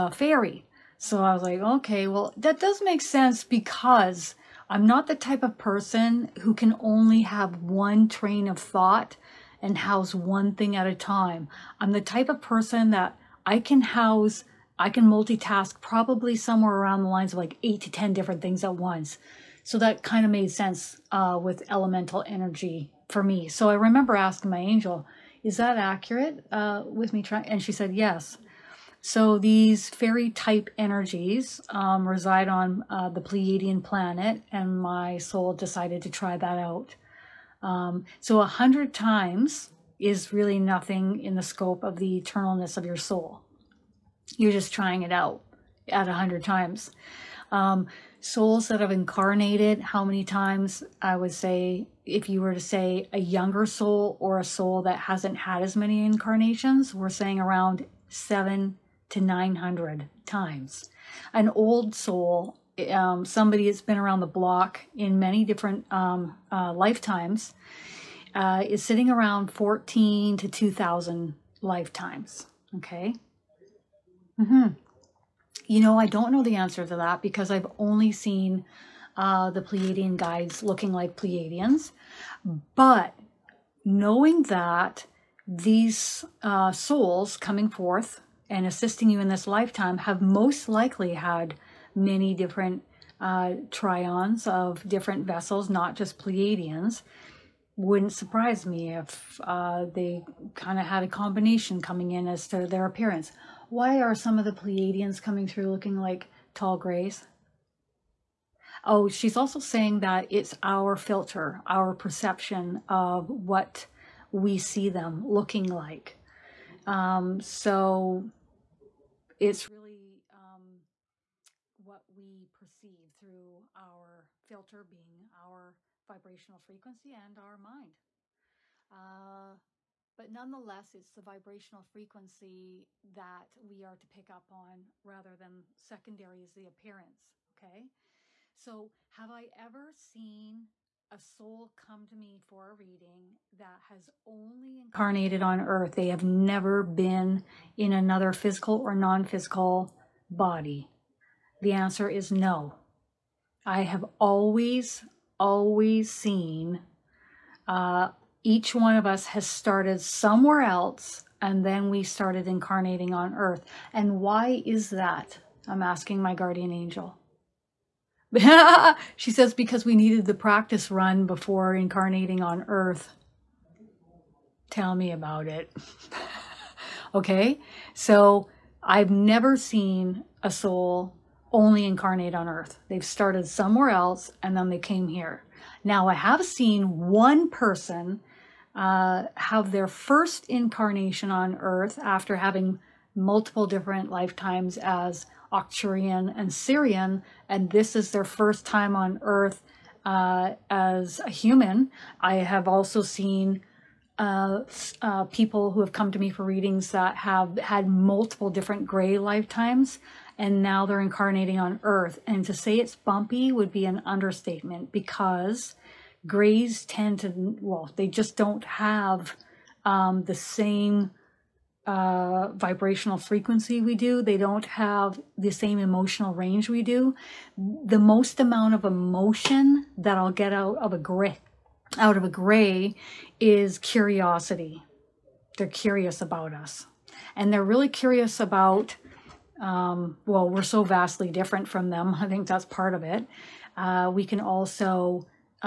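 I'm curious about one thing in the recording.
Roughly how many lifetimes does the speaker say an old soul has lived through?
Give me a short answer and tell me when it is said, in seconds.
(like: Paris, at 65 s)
14 to 2,000, at 69 s.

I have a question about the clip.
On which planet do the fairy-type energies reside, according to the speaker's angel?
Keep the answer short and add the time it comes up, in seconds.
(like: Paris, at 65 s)
Pleiadian planet, at 33 s.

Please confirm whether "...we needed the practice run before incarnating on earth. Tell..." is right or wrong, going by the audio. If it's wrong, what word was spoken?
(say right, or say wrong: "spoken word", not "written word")
right.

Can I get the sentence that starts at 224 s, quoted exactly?
They don't have the same emotional range we do.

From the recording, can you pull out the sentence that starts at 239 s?
Um, well, we're so vastly different from them.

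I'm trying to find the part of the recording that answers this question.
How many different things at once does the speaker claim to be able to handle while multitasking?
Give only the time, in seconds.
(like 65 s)
17 s.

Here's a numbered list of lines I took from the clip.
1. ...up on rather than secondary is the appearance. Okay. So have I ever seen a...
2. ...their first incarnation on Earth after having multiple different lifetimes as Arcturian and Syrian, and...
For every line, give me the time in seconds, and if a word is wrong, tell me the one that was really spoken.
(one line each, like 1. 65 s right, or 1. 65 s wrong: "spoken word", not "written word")
1. 134 s right
2. 189 s right.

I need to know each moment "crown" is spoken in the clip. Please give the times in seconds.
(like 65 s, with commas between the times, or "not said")
not said.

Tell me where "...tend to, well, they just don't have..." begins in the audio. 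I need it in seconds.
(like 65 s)
216 s.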